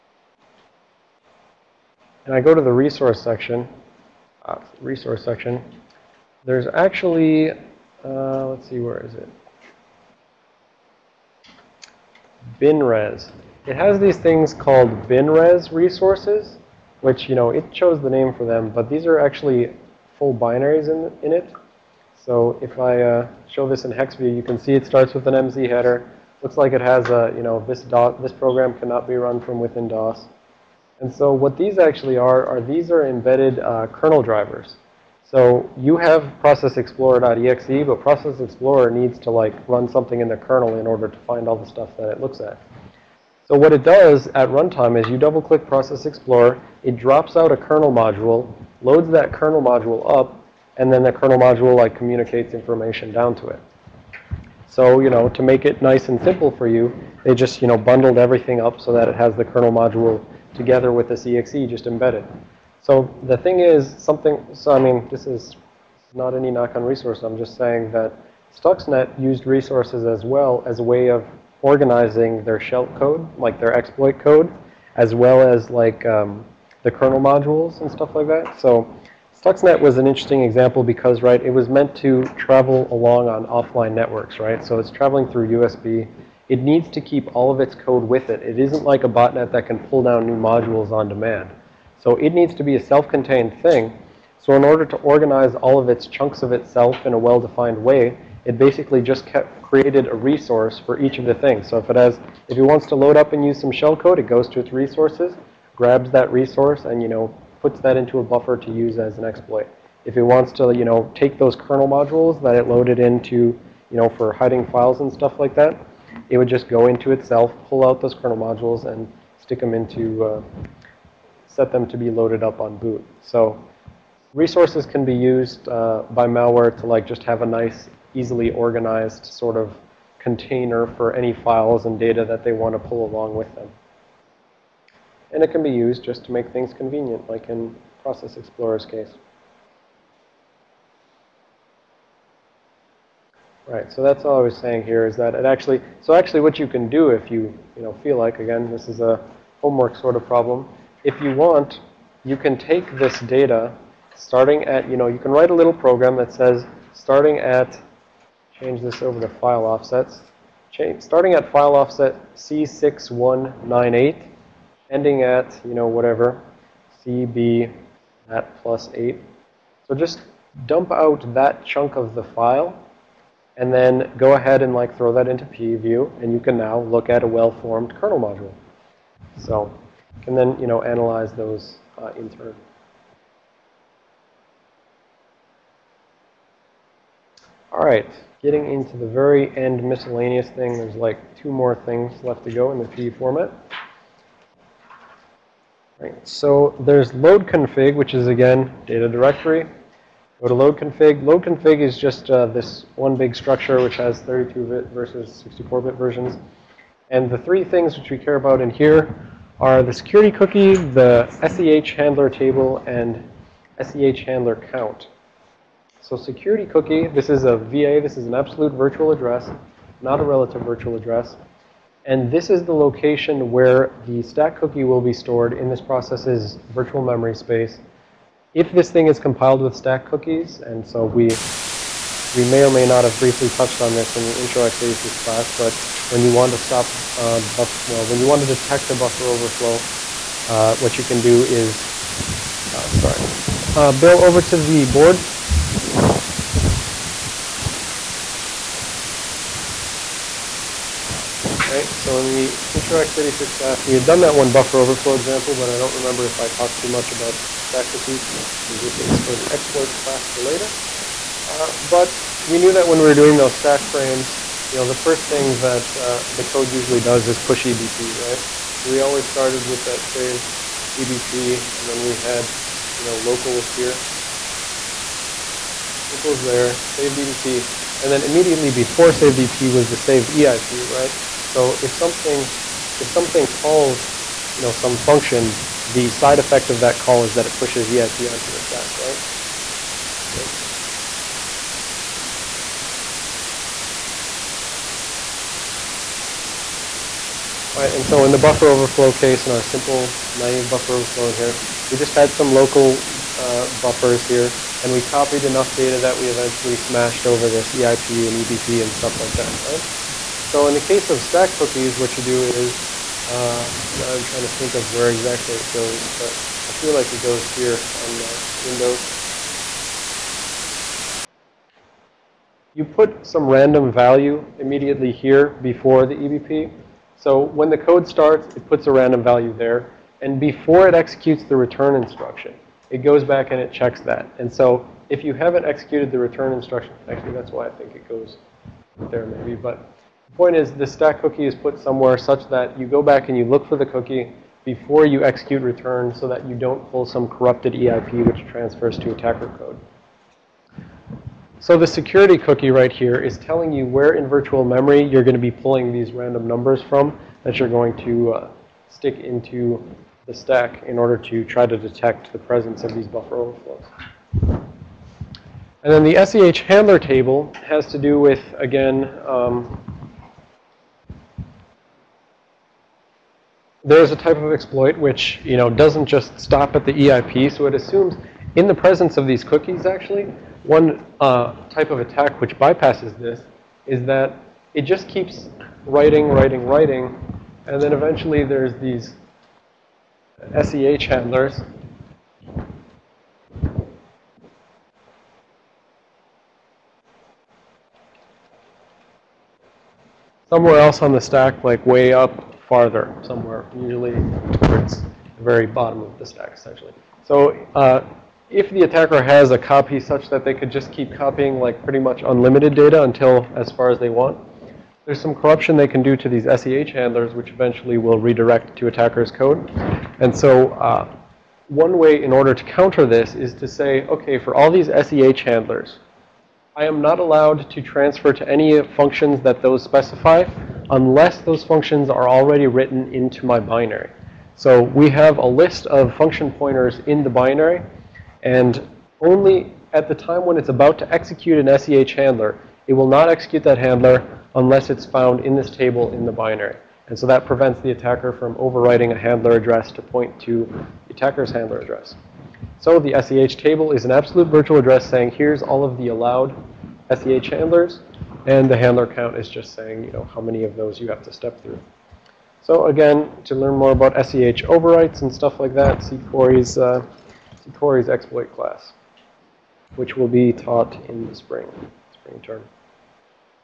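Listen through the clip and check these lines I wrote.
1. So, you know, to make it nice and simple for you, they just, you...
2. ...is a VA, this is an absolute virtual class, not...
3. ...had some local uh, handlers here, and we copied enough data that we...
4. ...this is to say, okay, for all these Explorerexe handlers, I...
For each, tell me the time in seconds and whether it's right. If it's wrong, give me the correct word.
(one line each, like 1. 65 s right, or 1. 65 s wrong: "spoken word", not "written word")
1. 54 s right
2. 217 s wrong: "address", not "class"
3. 302 s wrong: "buffers", not "handlers"
4. 423 s wrong: "SEH", not "Explorerexe".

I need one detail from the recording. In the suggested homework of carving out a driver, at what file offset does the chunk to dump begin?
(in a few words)
C6198.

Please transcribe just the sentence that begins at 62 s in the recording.
So the thing is something, so I mean, this is not any knock on resource.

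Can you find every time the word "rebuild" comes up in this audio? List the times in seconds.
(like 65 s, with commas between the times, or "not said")
not said.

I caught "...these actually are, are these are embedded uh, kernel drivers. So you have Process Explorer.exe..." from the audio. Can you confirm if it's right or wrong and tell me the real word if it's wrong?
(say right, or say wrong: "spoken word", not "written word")
right.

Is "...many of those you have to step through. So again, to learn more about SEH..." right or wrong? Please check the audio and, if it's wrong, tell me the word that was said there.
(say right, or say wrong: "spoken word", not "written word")
right.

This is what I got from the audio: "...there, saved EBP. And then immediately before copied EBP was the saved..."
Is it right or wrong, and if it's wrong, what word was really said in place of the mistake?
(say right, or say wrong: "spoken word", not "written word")
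wrong: "saved", not "copied".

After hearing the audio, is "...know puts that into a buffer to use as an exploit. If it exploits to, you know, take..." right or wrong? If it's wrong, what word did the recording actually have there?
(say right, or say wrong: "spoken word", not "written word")
wrong: "wants", not "exploits".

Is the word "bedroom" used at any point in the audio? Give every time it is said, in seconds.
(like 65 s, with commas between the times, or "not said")
not said.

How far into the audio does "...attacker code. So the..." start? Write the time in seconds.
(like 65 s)
349 s.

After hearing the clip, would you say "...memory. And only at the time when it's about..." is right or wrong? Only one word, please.
wrong.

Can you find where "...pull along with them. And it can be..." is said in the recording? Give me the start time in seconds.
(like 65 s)
132 s.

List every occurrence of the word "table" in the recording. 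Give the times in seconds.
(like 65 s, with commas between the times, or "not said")
212 s, 366 s, 445 s, 453 s.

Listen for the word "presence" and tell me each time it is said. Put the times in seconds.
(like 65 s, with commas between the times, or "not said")
362 s, 378 s.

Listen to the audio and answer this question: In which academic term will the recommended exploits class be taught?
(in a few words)
spring term.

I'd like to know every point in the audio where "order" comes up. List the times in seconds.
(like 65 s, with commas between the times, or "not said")
40 s, 94 s, 360 s, 422 s.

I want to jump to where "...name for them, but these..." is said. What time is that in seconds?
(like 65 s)
18 s.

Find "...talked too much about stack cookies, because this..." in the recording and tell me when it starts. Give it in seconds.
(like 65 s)
256 s.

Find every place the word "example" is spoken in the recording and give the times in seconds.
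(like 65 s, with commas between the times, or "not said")
80 s, 255 s.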